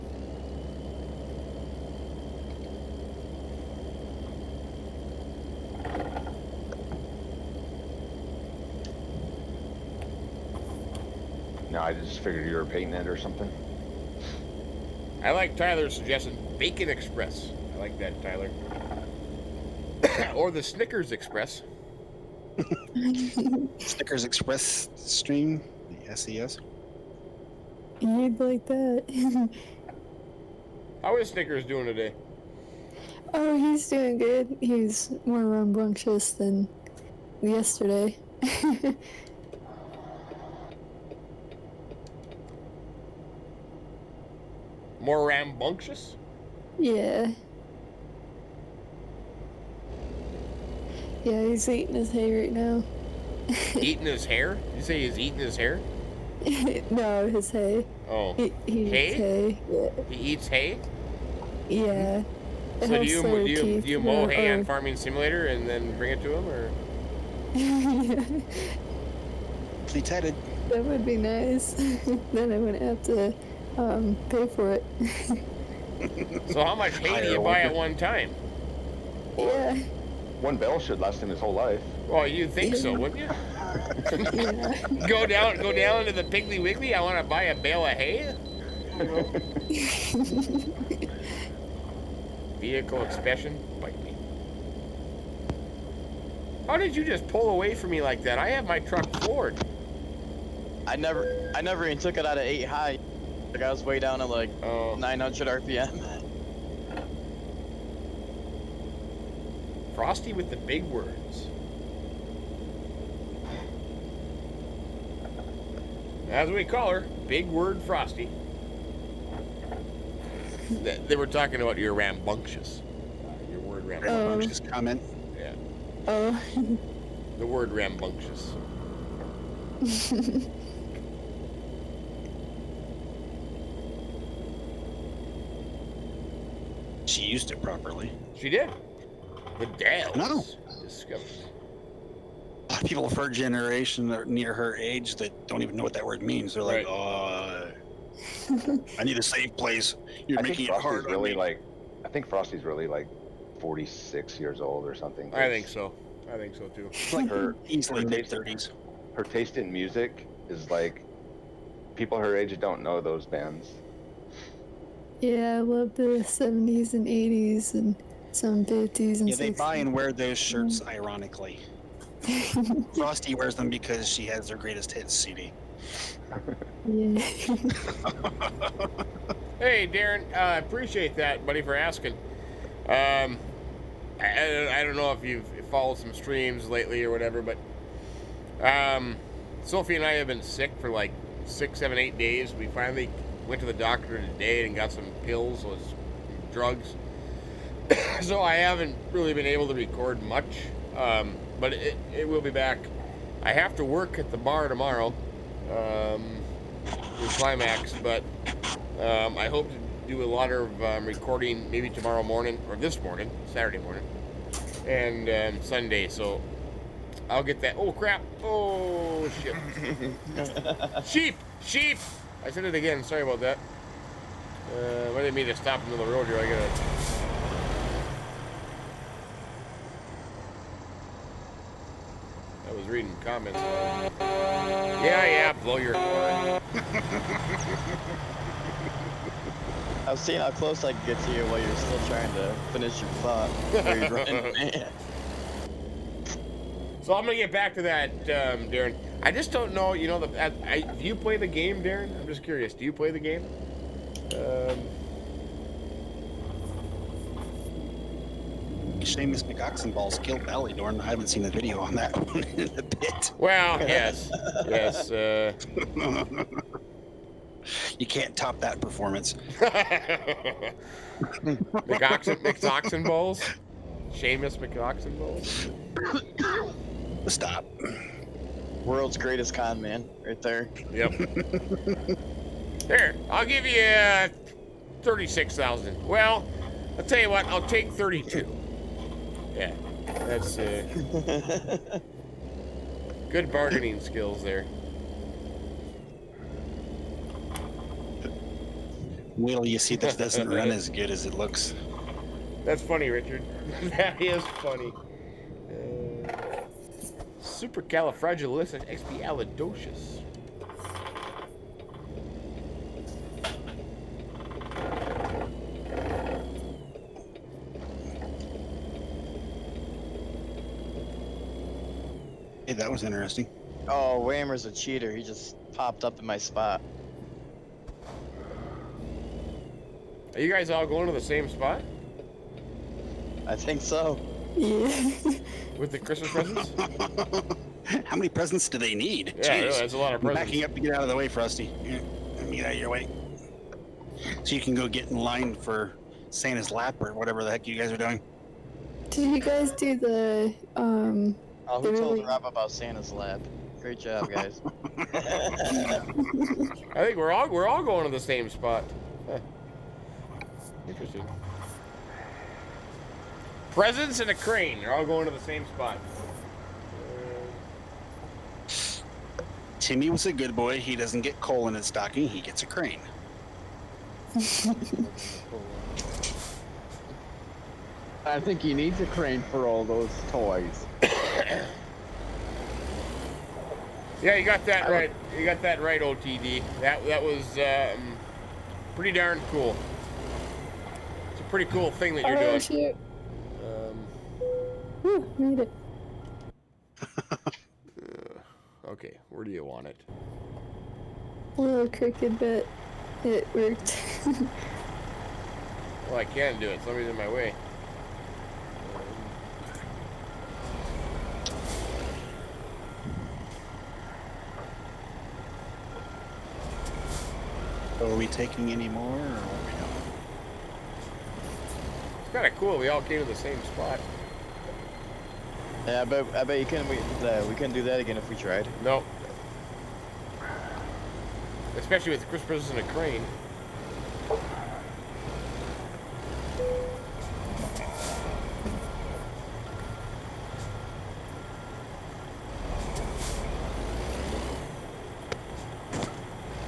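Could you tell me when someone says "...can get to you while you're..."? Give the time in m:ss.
4:00.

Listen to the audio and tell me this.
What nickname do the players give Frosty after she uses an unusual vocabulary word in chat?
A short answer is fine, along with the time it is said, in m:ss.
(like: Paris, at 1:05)
Big Word Frosty, at 1:57.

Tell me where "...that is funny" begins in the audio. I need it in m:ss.
5:03.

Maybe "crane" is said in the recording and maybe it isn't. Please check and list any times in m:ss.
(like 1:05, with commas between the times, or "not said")
6:04, 6:12, 6:19, 7:12.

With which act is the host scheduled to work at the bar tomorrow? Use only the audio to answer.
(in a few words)
Climax.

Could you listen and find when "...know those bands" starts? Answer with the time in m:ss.
2:42.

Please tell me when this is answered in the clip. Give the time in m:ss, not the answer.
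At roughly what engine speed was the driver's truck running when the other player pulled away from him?
1:44.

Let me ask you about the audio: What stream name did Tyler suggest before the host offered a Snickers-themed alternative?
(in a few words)
Bacon Express.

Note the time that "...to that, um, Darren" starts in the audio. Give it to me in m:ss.
4:07.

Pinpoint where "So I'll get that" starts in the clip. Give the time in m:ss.
3:36.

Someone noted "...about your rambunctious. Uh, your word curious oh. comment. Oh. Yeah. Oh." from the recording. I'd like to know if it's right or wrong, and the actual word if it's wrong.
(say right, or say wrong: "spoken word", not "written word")
wrong: "rambunctious", not "curious".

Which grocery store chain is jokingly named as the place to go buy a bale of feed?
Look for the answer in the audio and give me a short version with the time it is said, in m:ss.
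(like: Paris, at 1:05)
Piggly Wiggly, at 1:26.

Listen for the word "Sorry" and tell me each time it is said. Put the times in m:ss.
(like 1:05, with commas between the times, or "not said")
3:43.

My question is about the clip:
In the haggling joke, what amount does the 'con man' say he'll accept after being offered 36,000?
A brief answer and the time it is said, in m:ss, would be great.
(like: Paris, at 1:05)
32, at 4:47.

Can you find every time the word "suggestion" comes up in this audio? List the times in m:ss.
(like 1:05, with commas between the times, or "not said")
0:15.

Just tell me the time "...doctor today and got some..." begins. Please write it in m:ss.
3:13.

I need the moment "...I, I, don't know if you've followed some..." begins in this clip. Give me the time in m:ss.
3:04.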